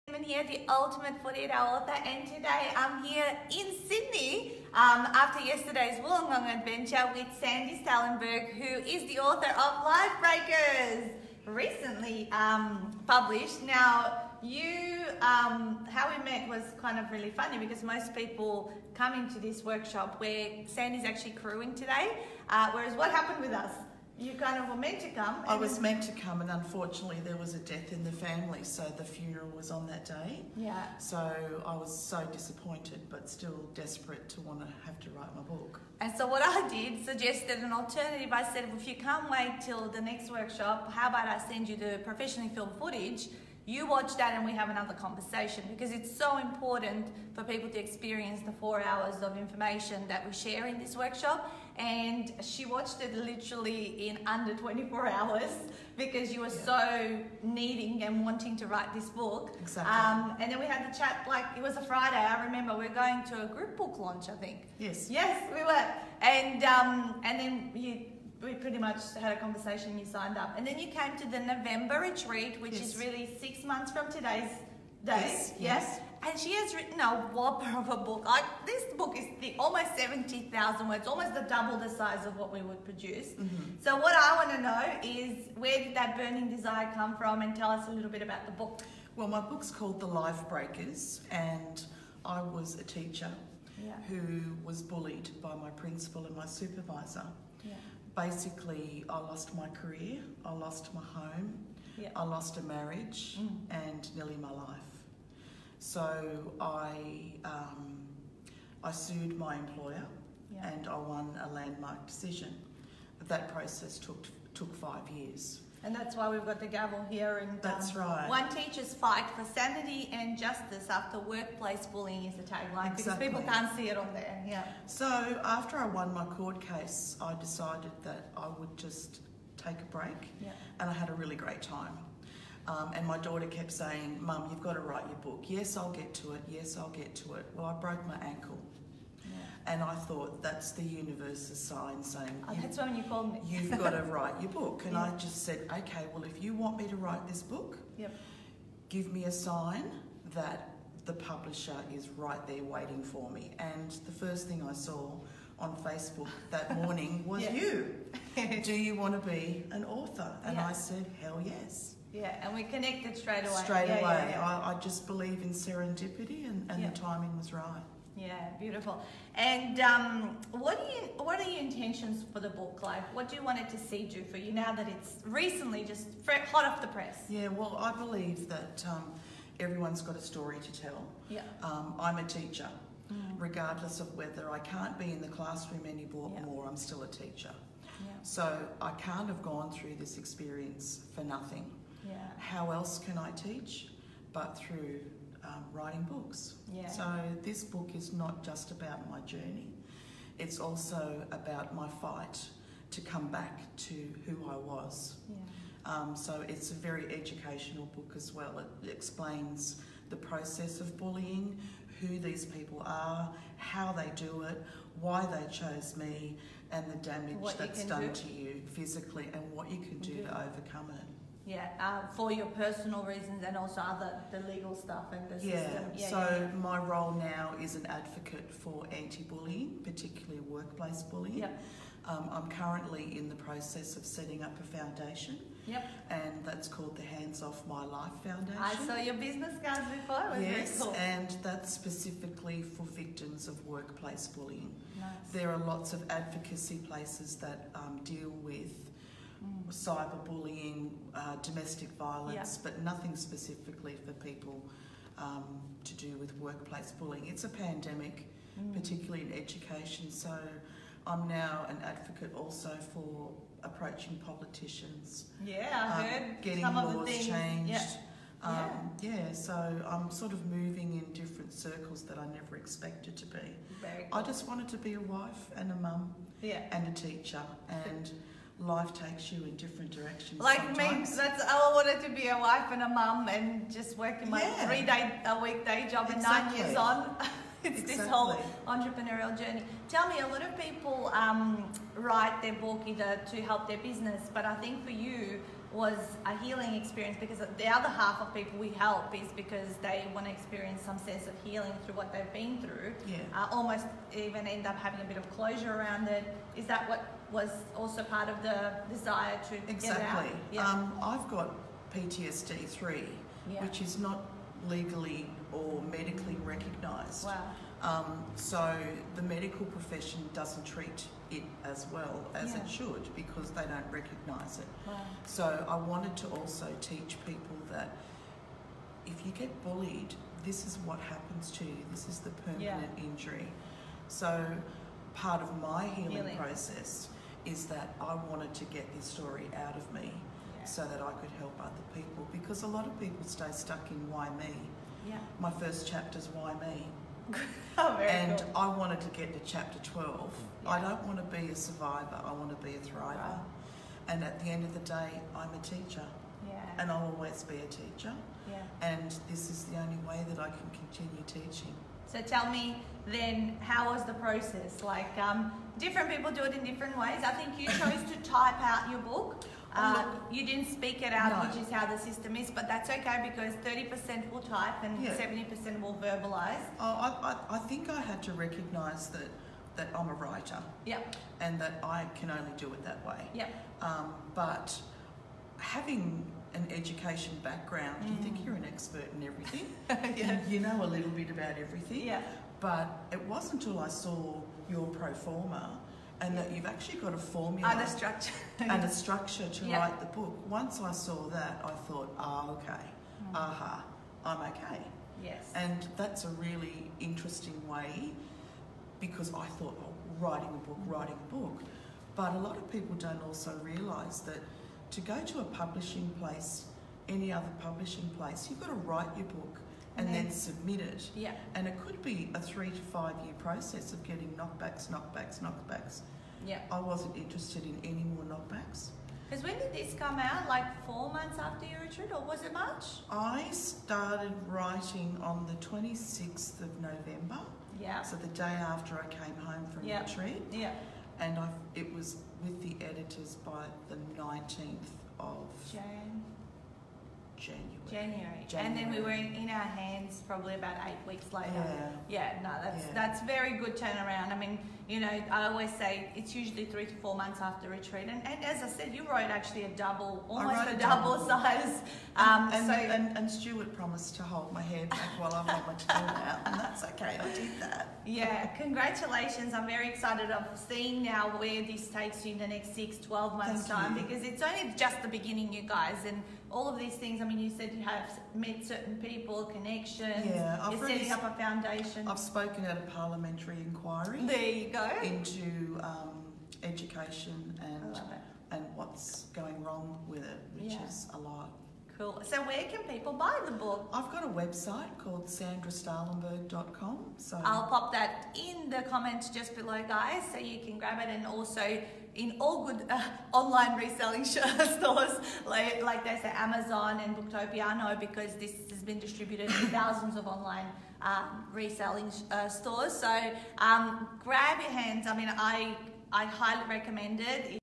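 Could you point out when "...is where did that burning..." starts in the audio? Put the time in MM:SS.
01:25.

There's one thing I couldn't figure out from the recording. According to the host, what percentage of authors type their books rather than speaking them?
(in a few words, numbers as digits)
30%.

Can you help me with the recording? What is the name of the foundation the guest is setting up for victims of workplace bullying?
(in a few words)
Hands Off My Life Foundation.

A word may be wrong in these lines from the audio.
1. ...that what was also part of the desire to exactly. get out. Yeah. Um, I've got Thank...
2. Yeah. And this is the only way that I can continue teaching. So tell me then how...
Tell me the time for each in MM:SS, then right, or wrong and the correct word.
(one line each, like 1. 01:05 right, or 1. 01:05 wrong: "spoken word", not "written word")
1. 05:06 wrong: "PTSD", not "Thank"
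2. 05:58 right.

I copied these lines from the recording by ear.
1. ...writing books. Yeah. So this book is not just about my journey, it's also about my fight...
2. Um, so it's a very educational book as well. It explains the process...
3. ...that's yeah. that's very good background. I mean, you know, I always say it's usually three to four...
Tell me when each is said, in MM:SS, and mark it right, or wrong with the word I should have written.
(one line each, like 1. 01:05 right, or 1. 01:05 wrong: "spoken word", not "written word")
1. 03:15 right
2. 03:25 right
3. 07:32 wrong: "turnaround", not "background".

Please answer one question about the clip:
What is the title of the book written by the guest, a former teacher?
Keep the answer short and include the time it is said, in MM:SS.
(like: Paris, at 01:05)
The Life Breakers, at 01:29.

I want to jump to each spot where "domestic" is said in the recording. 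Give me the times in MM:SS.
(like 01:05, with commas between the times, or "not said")
04:11.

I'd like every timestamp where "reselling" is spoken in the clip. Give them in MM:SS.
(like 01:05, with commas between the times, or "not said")
08:23, 08:31.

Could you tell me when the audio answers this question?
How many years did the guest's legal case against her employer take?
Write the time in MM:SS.
01:54.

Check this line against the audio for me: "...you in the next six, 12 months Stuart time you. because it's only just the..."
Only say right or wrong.
wrong.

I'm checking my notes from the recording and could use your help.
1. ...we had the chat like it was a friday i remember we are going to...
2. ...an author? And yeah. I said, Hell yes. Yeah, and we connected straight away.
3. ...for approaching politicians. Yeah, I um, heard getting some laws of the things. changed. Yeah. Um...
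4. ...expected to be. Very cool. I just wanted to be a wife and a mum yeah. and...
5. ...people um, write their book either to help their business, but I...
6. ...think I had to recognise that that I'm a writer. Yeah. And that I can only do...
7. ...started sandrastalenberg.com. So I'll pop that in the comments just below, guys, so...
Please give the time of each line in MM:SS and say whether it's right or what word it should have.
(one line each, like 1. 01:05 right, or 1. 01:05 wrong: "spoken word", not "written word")
1. 01:00 right
2. 02:39 right
3. 04:22 right
4. 04:32 right
5. 04:50 right
6. 06:17 right
7. 08:14 wrong: "called", not "started".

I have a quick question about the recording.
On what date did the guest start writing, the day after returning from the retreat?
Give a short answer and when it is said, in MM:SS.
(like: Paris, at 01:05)
26 November, at 07:15.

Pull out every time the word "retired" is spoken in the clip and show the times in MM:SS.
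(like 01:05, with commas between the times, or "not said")
not said.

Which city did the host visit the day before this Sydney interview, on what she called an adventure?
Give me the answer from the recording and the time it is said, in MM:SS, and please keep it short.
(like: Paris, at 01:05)
Wollongong, at 00:05.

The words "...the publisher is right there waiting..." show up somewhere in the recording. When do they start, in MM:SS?
02:31.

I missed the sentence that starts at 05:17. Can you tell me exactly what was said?
Um, so the medical profession doesn't treat it as well as yeah.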